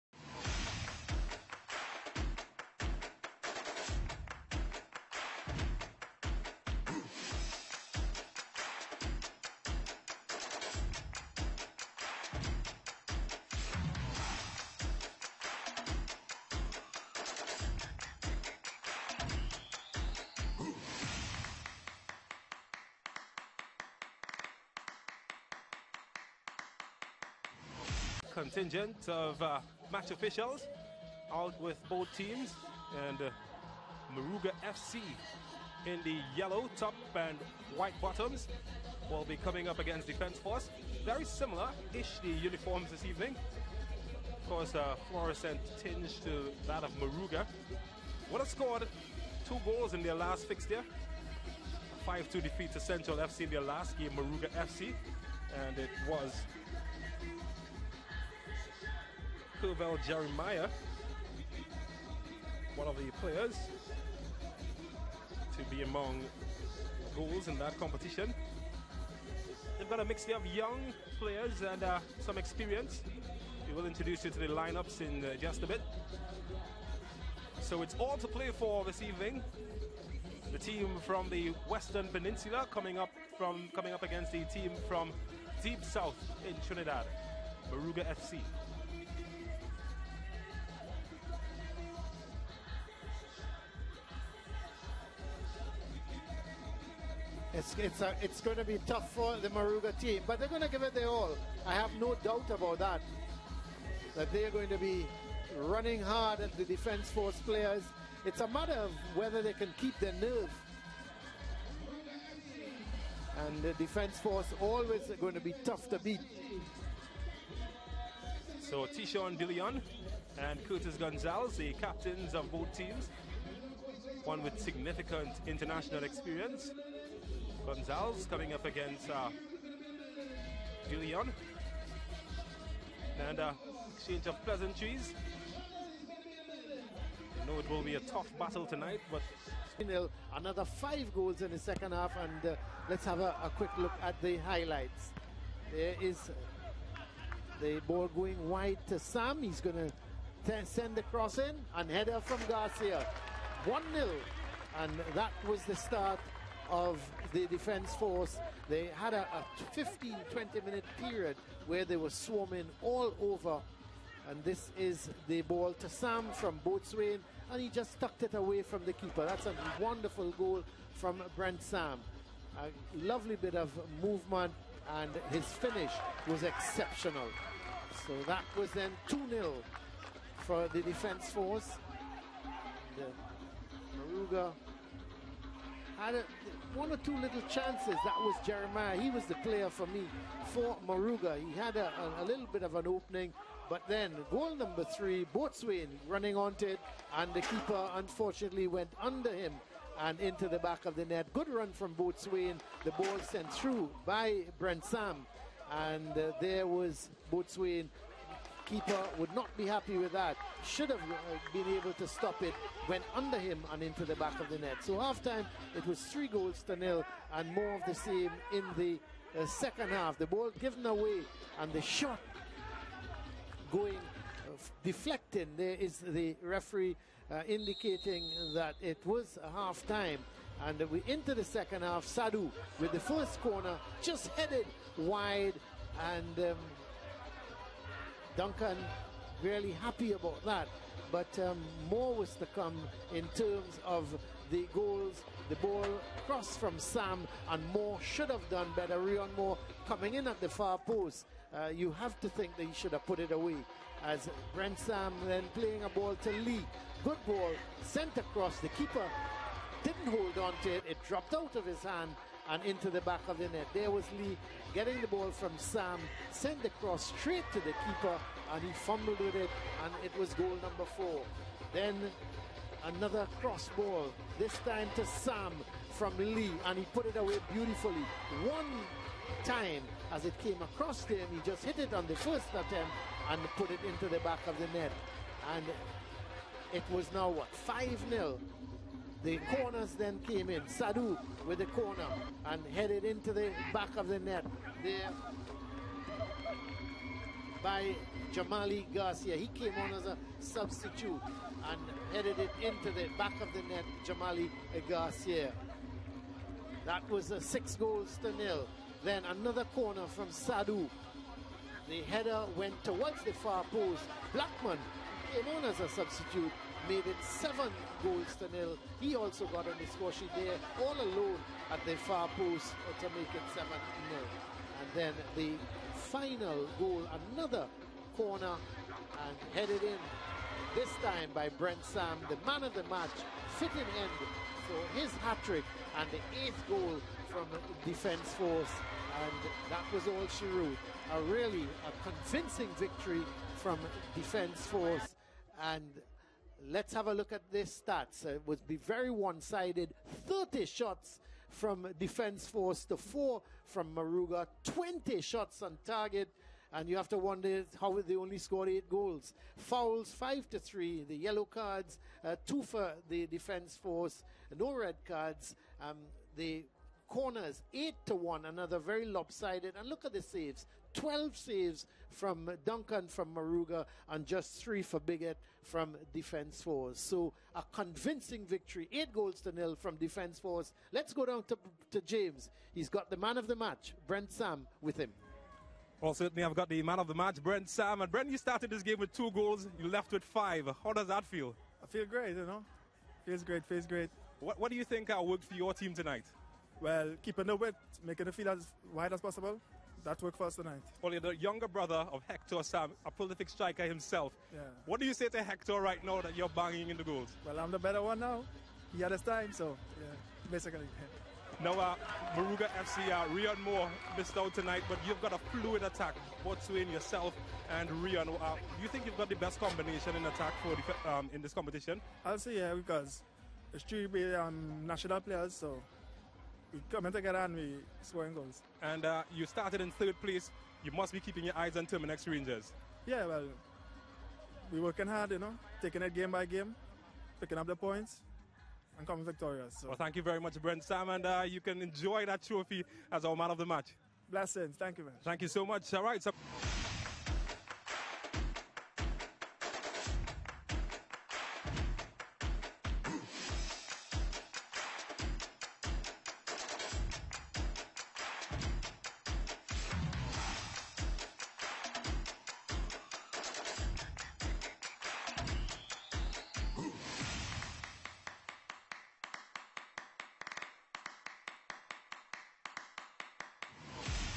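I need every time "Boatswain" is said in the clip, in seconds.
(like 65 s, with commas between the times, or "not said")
166 s, 195 s, 201 s, 207 s, 416 s.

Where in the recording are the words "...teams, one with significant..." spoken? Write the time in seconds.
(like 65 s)
122 s.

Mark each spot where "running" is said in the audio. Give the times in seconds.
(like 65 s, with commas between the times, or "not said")
105 s, 196 s.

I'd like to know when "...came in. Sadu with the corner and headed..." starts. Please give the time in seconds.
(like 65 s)
290 s.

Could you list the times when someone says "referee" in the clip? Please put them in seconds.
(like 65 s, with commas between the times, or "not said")
226 s.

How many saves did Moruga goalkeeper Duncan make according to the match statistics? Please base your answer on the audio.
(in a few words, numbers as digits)
12.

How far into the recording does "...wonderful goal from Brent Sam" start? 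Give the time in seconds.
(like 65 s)
169 s.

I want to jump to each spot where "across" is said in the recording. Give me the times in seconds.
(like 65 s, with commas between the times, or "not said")
258 s, 280 s.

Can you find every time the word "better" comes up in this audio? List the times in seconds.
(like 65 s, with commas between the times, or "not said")
248 s, 407 s.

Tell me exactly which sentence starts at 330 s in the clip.
This time by Brent Sam, the man of the match, fitting end.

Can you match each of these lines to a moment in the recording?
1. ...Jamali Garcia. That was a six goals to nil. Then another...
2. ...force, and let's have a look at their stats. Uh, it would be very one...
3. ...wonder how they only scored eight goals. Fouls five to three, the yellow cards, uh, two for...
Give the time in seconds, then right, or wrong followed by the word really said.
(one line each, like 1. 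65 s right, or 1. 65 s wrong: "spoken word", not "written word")
1. 304 s right
2. 344 s right
3. 357 s right.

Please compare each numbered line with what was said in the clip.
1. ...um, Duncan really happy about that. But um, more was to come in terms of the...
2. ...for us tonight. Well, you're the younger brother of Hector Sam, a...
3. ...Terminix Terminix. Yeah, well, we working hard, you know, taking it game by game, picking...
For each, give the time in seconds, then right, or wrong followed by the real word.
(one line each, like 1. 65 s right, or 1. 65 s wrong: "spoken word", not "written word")
1. 236 s right
2. 400 s right
3. 431 s wrong: "Rangers", not "Terminix".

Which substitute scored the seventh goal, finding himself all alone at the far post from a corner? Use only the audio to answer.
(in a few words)
Blackman.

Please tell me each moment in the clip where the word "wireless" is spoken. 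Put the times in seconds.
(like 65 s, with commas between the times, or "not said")
not said.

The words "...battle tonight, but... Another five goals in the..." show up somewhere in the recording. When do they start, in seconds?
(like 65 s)
138 s.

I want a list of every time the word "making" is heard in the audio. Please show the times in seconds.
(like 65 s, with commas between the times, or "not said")
398 s.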